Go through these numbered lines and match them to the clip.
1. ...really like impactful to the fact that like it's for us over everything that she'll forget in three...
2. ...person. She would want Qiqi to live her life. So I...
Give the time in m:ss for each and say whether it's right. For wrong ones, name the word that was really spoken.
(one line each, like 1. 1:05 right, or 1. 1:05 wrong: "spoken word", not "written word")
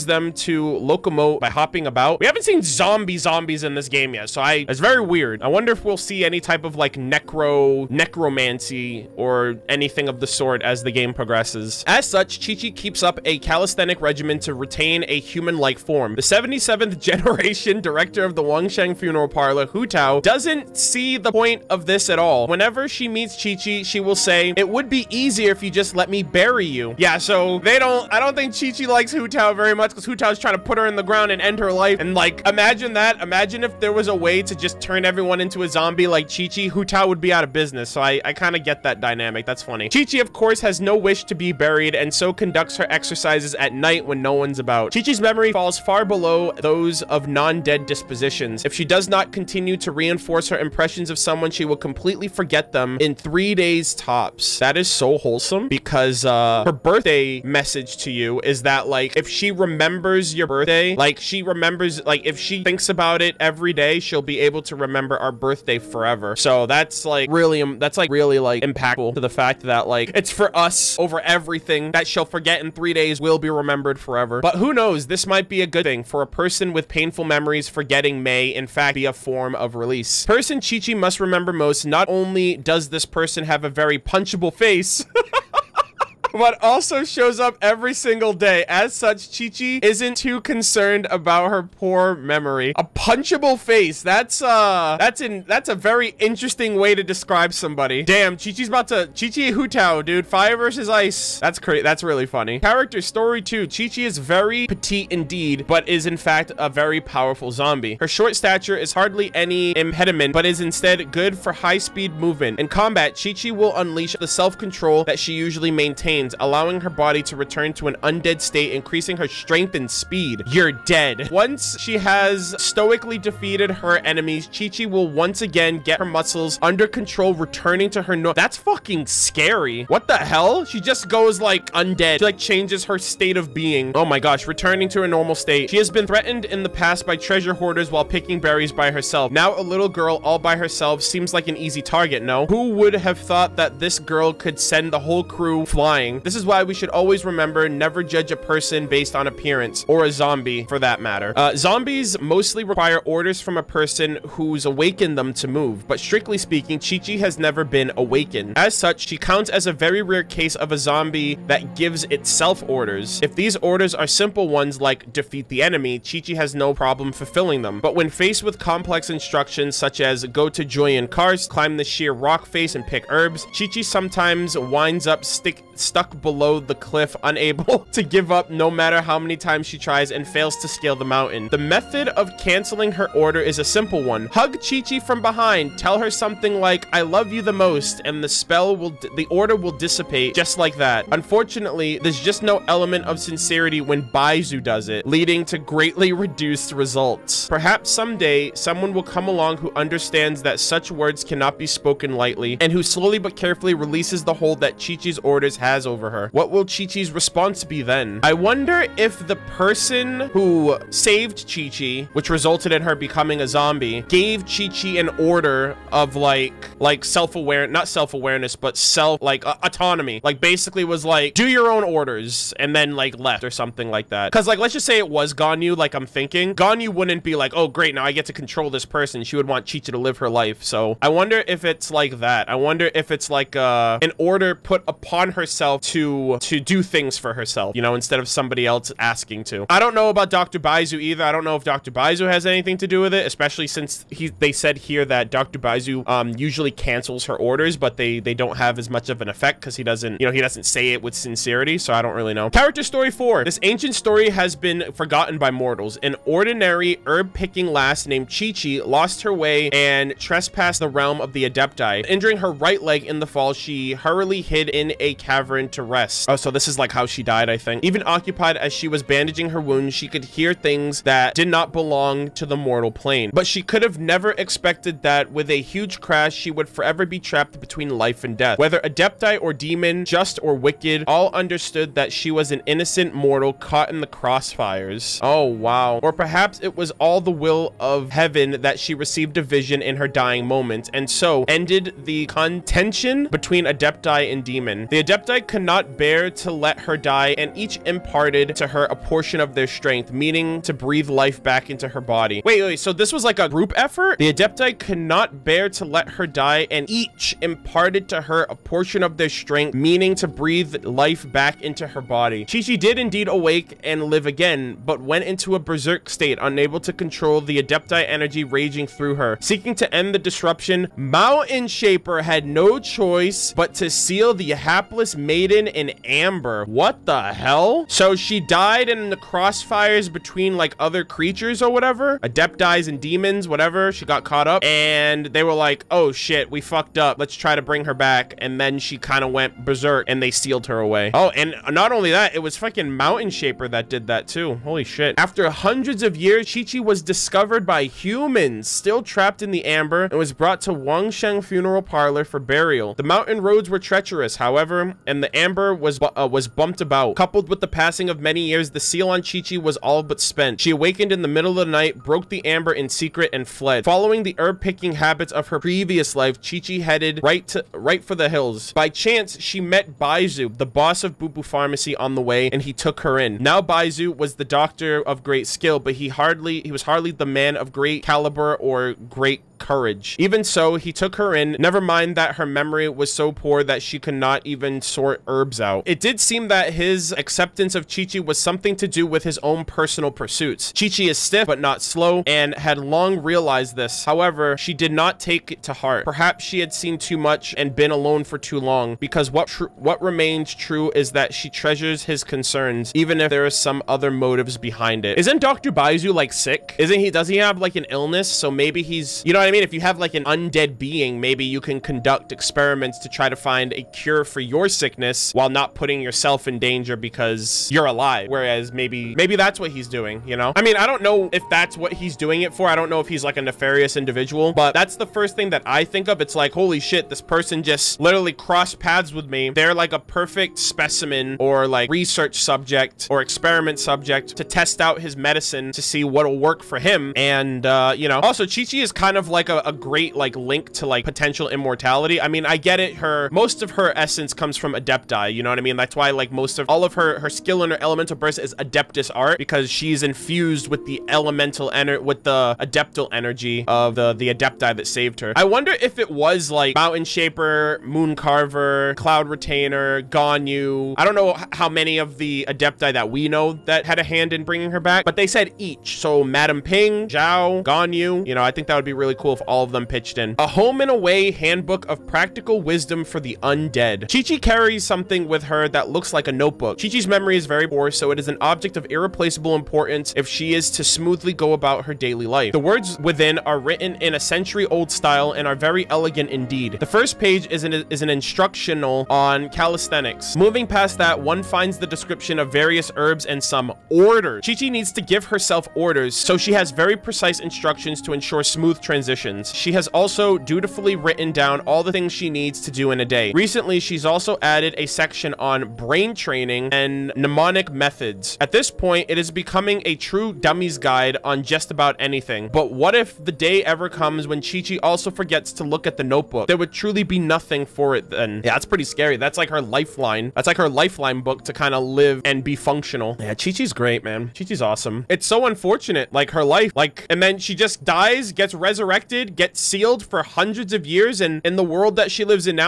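1. 1:08 right
2. 3:48 right.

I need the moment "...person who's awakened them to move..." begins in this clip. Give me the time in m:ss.
2:33.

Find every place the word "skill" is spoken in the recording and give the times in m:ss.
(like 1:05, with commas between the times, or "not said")
6:15, 7:27.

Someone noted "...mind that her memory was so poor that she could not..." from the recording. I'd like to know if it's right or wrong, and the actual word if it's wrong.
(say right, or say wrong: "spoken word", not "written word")
right.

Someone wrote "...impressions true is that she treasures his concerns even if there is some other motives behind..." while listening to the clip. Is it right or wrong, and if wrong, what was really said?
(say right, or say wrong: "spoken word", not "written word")
wrong: "remains", not "impressions".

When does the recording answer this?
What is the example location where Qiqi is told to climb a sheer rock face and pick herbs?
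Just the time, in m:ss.
2:50.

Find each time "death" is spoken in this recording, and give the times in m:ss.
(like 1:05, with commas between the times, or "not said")
4:38.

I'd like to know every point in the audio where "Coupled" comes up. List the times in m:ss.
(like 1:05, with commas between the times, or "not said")
5:57.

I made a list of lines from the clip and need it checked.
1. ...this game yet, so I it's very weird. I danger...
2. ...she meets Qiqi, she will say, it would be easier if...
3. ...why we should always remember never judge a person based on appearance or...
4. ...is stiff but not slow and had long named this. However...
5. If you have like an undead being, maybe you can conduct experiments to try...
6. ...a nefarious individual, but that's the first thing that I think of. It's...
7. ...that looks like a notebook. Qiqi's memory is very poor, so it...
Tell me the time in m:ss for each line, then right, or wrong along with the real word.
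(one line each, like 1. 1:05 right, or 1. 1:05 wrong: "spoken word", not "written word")
1. 0:03 wrong: "wonder", not "danger"
2. 0:22 right
3. 2:26 right
4. 6:31 wrong: "realized", not "named"
5. 6:49 right
6. 7:03 right
7. 7:55 right.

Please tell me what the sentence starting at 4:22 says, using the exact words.
Injuring her right leg in the fall, she hurriedly hid in a cavern to rest.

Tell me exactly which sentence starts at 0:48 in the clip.
If she does not continue to reinforce her impressions of someone, she will completely forget them in three days tops.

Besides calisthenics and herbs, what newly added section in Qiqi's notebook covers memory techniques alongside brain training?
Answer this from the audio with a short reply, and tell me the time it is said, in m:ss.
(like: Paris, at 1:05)
mnemonic methods, at 8:27.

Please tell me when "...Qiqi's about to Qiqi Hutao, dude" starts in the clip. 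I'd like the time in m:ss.
1:38.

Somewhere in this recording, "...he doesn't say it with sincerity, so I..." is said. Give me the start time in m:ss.
4:10.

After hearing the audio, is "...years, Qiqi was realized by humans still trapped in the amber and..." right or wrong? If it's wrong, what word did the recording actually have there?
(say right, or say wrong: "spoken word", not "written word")
wrong: "discovered", not "realized".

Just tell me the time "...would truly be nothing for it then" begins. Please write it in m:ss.
8:36.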